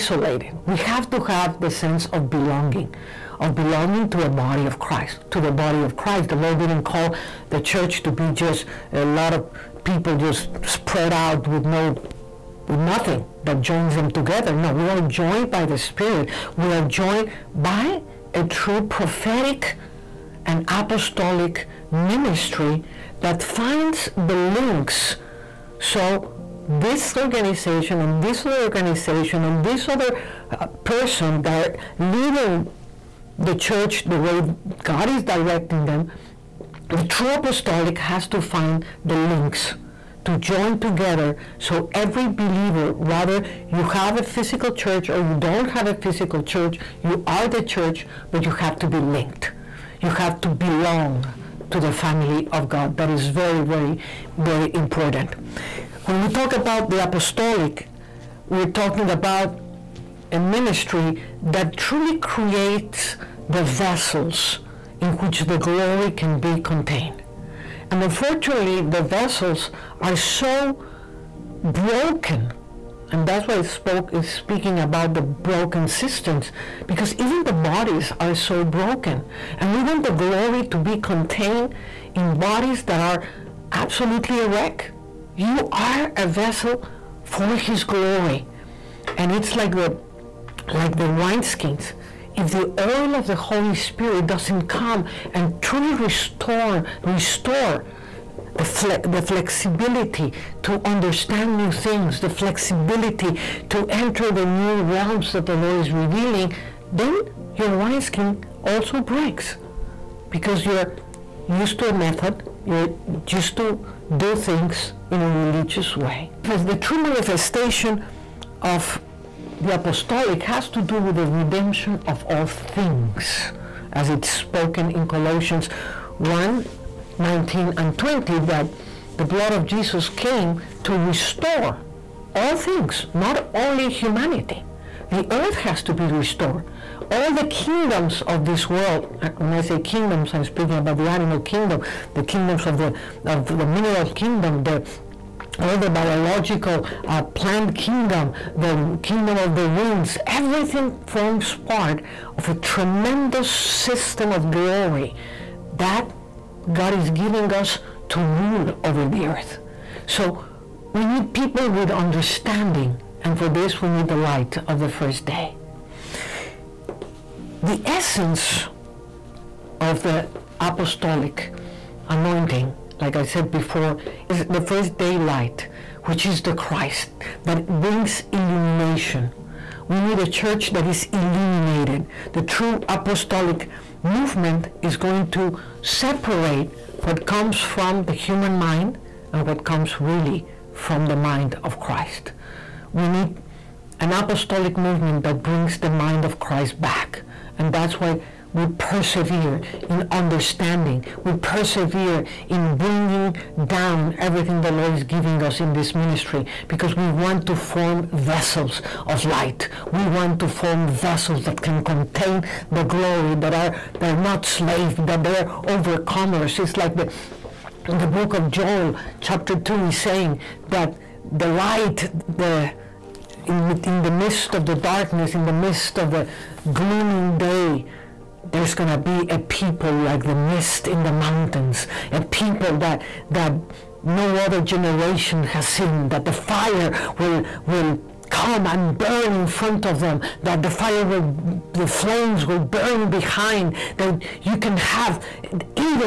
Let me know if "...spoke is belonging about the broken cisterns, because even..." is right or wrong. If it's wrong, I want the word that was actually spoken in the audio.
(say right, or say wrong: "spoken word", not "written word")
wrong: "speaking", not "belonging".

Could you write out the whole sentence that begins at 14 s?
No, we are joined by the Spirit.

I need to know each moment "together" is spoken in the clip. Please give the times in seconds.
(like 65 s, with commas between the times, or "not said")
14 s, 40 s.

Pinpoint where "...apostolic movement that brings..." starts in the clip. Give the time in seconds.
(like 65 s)
194 s.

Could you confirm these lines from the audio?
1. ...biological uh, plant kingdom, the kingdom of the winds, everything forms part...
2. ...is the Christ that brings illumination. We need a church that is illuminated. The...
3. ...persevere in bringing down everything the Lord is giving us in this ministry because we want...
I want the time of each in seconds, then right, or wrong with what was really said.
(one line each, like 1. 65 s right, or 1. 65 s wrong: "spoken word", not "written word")
1. 145 s right
2. 176 s right
3. 201 s right.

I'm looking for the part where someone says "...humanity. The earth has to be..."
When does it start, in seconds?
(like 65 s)
133 s.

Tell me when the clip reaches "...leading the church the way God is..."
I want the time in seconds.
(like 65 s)
31 s.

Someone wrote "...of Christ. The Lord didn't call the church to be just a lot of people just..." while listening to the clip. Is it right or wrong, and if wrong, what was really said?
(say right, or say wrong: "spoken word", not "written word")
right.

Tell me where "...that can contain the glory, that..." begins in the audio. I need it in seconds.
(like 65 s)
211 s.